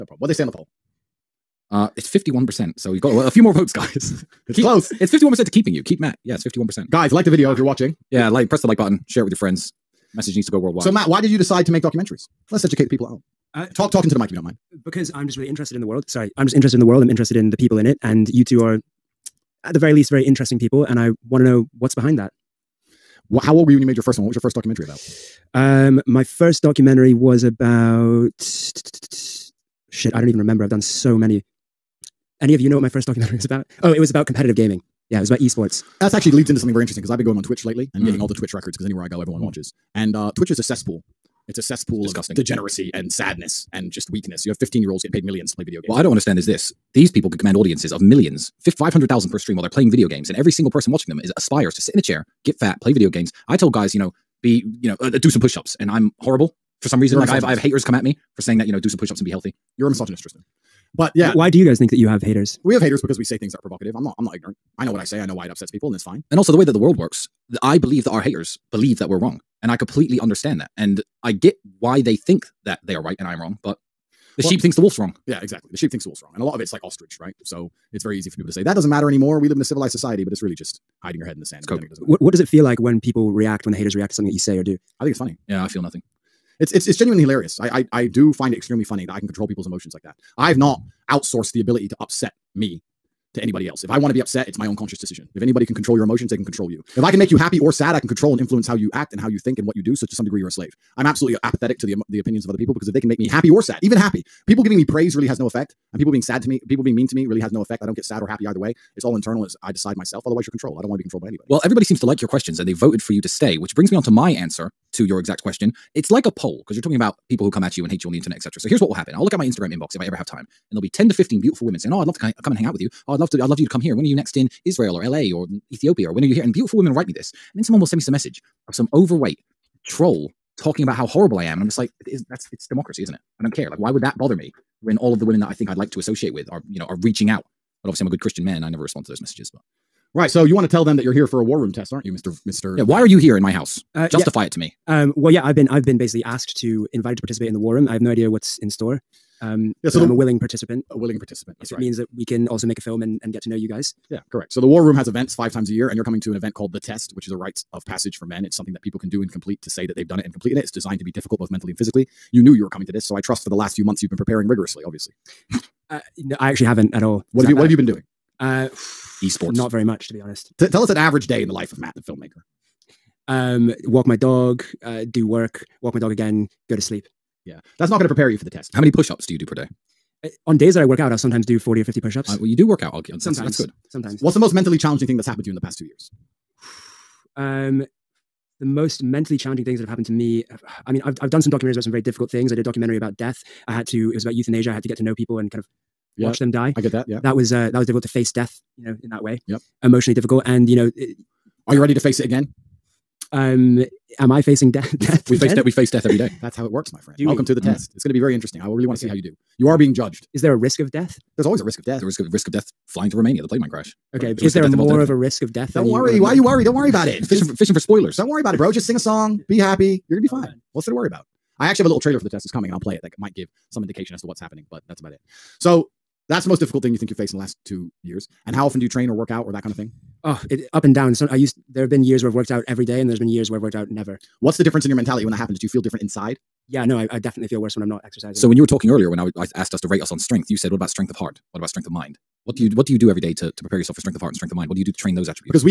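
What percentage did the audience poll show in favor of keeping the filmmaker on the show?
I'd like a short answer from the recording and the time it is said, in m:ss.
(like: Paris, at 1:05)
51%, at 0:02.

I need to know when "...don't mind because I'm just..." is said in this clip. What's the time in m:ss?
0:14.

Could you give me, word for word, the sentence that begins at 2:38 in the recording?
It's something that people can do and complete to say that they've done it and completed it.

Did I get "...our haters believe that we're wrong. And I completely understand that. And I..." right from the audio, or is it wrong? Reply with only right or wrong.
right.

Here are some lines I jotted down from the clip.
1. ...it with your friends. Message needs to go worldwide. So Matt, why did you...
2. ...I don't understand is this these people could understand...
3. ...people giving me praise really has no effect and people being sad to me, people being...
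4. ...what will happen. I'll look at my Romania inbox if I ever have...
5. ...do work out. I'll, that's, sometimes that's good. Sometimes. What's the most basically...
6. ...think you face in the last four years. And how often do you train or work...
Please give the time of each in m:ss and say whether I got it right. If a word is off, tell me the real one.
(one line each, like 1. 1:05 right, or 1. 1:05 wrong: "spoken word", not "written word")
1. 0:09 right
2. 0:45 wrong: "command", not "understand"
3. 1:44 right
4. 1:58 wrong: "Instagram", not "Romania"
5. 3:02 wrong: "mentally", not "basically"
6. 3:46 wrong: "two", not "four".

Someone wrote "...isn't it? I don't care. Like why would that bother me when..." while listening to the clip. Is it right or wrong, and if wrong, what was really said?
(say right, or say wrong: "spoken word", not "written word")
right.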